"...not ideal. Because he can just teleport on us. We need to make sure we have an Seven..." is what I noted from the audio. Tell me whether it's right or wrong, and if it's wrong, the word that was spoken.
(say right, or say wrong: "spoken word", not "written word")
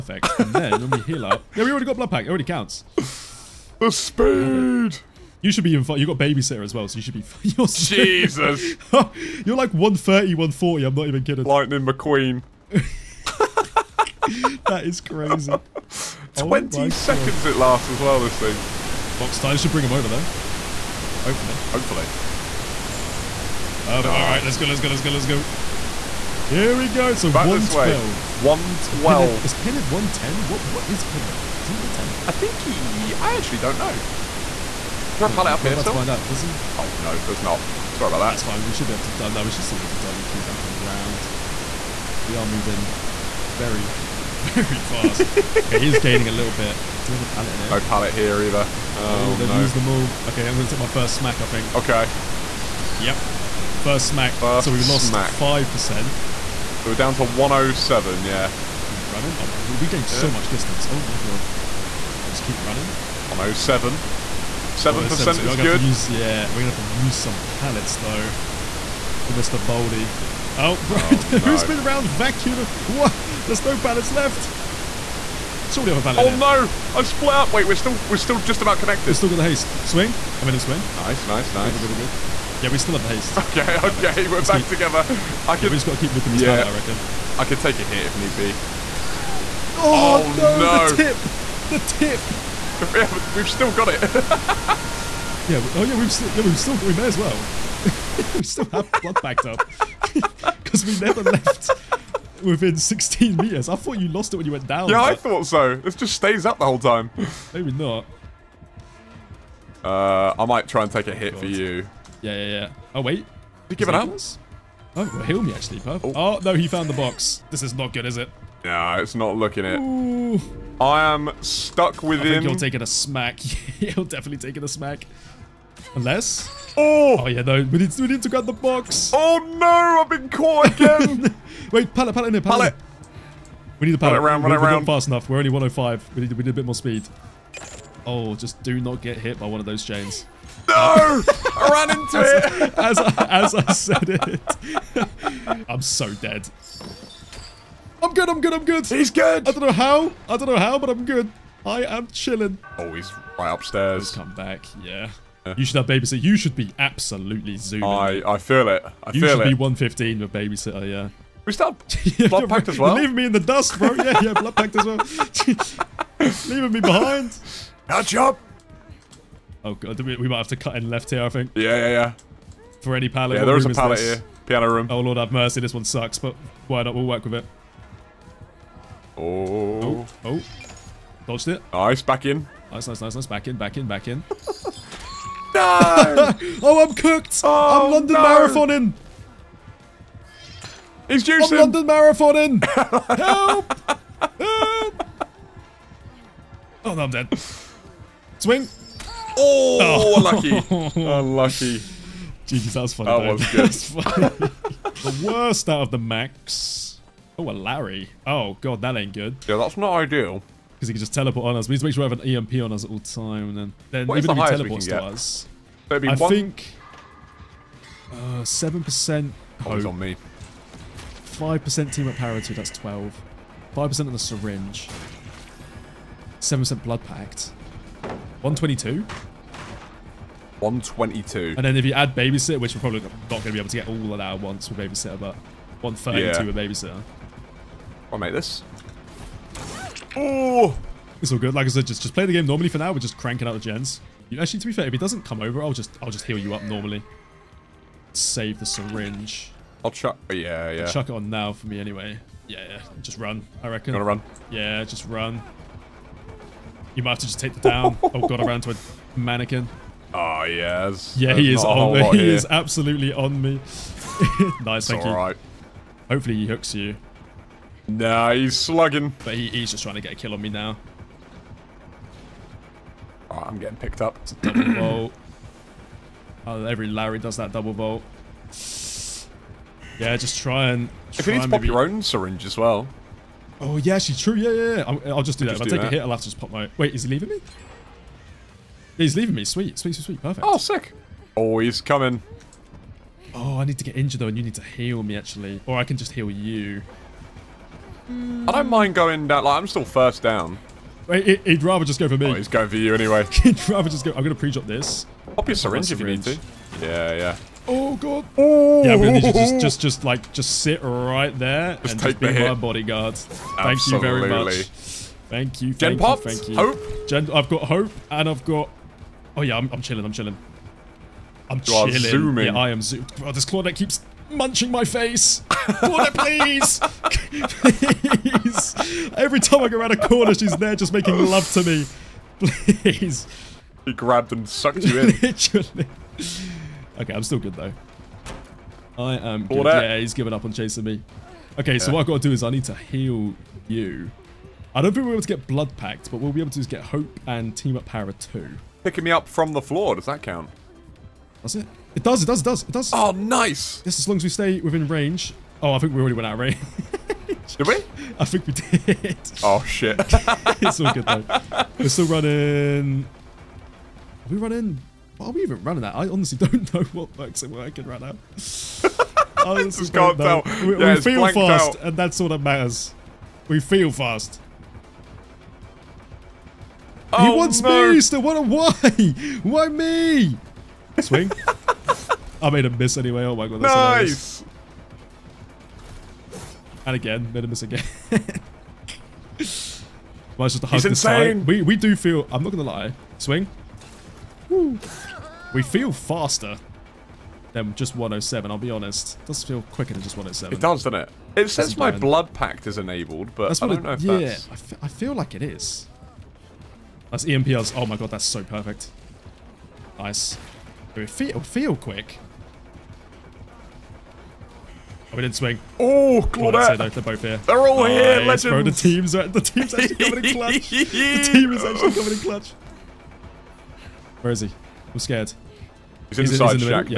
wrong: "EMP", not "Seven".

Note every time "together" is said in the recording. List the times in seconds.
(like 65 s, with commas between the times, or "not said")
84 s.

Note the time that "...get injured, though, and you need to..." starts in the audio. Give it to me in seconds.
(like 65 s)
293 s.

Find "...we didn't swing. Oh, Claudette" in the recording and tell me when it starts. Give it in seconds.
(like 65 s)
415 s.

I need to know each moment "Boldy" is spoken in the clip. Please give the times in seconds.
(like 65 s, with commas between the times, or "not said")
69 s.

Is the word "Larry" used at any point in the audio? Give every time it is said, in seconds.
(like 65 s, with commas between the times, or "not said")
207 s, 276 s.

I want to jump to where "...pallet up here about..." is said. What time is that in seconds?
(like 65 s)
35 s.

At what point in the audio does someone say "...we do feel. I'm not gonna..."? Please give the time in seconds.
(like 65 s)
391 s.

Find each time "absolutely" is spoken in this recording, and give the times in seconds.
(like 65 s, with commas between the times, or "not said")
156 s, 262 s.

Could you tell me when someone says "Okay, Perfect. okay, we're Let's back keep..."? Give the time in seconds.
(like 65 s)
83 s.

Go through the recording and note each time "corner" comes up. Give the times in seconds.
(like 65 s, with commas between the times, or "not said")
330 s.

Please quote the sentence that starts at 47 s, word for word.
Do we have a pallet in here?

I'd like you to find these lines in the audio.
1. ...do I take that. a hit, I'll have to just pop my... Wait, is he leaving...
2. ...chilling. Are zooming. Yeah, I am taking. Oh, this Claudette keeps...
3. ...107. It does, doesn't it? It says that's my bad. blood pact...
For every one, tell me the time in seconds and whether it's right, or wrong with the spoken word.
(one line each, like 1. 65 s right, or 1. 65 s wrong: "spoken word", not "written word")
1. 285 s right
2. 321 s wrong: "zooming", not "taking"
3. 400 s right.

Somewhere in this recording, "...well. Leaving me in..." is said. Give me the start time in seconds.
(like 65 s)
162 s.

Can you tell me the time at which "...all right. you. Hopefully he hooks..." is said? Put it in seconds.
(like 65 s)
265 s.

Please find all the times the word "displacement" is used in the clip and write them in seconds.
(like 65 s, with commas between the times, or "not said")
not said.